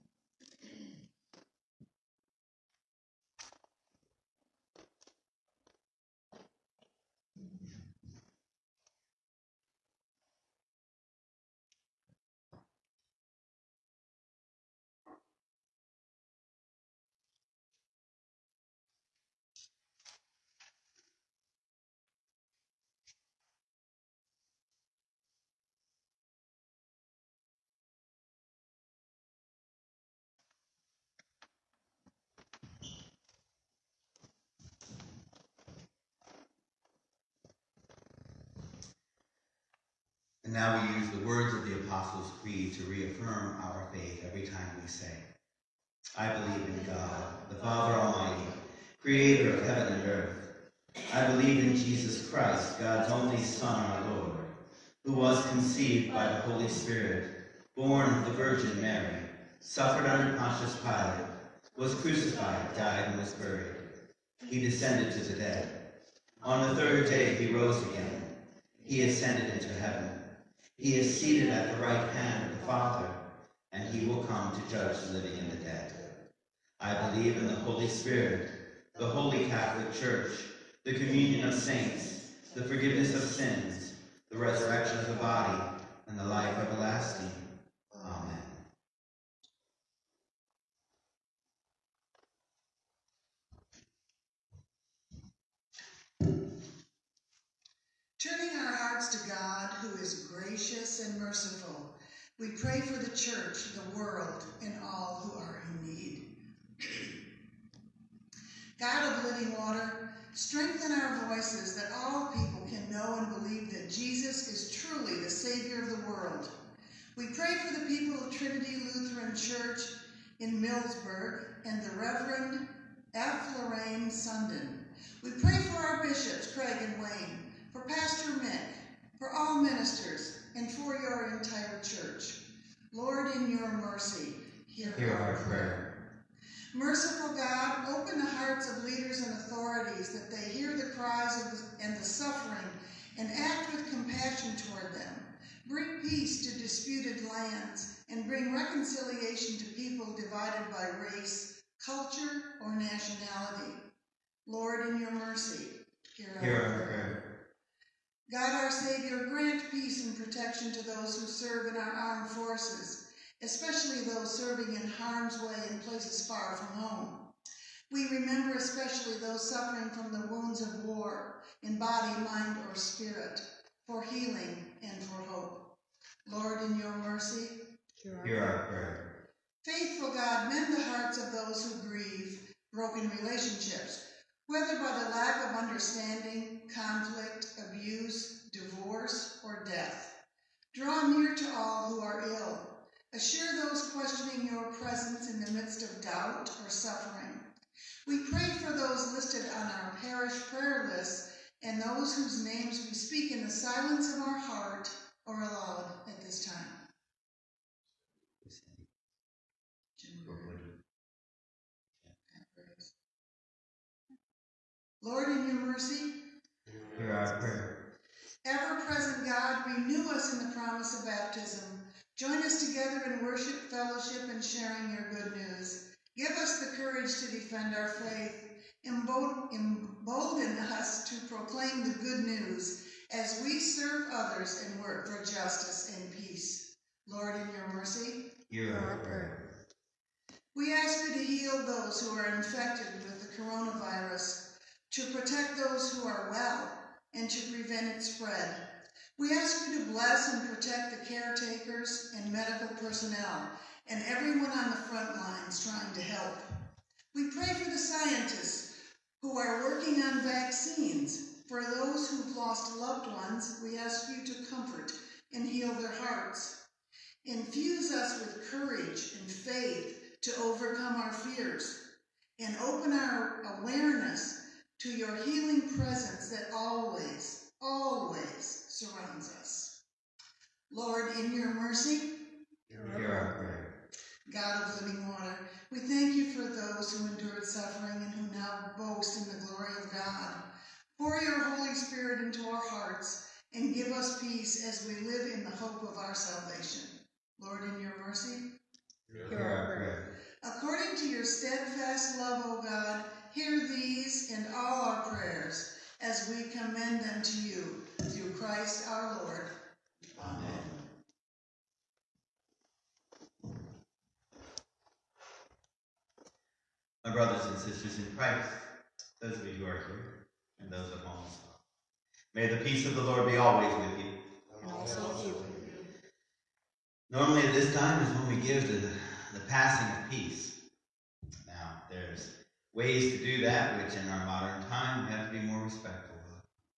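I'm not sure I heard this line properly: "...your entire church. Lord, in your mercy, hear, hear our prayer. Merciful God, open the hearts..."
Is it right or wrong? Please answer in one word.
right.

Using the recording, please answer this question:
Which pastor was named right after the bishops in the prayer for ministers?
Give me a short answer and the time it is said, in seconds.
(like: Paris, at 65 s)
Pastor Mick, at 127 s.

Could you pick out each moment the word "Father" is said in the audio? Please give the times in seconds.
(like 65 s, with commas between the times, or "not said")
47 s, 72 s.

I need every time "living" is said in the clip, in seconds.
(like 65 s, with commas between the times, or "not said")
75 s, 109 s, 284 s.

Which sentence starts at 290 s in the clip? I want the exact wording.
Pour your Holy Spirit into our hearts and give us peace as we live in the hope of our salvation.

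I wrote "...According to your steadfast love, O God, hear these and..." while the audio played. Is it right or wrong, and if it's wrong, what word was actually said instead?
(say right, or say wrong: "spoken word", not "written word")
right.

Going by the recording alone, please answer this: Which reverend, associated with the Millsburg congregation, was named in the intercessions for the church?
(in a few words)
F. Lorraine Sundin.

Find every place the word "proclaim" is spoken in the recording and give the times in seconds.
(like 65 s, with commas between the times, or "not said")
231 s.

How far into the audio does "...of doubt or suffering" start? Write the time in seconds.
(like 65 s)
195 s.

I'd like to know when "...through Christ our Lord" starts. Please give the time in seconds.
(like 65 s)
308 s.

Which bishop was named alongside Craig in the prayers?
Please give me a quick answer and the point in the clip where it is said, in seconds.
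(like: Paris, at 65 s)
Wayne, at 127 s.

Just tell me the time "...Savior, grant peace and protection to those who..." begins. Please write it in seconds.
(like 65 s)
158 s.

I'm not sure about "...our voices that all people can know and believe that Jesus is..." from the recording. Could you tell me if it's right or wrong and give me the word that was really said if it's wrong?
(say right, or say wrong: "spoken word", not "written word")
right.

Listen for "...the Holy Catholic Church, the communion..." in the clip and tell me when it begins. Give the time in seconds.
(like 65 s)
78 s.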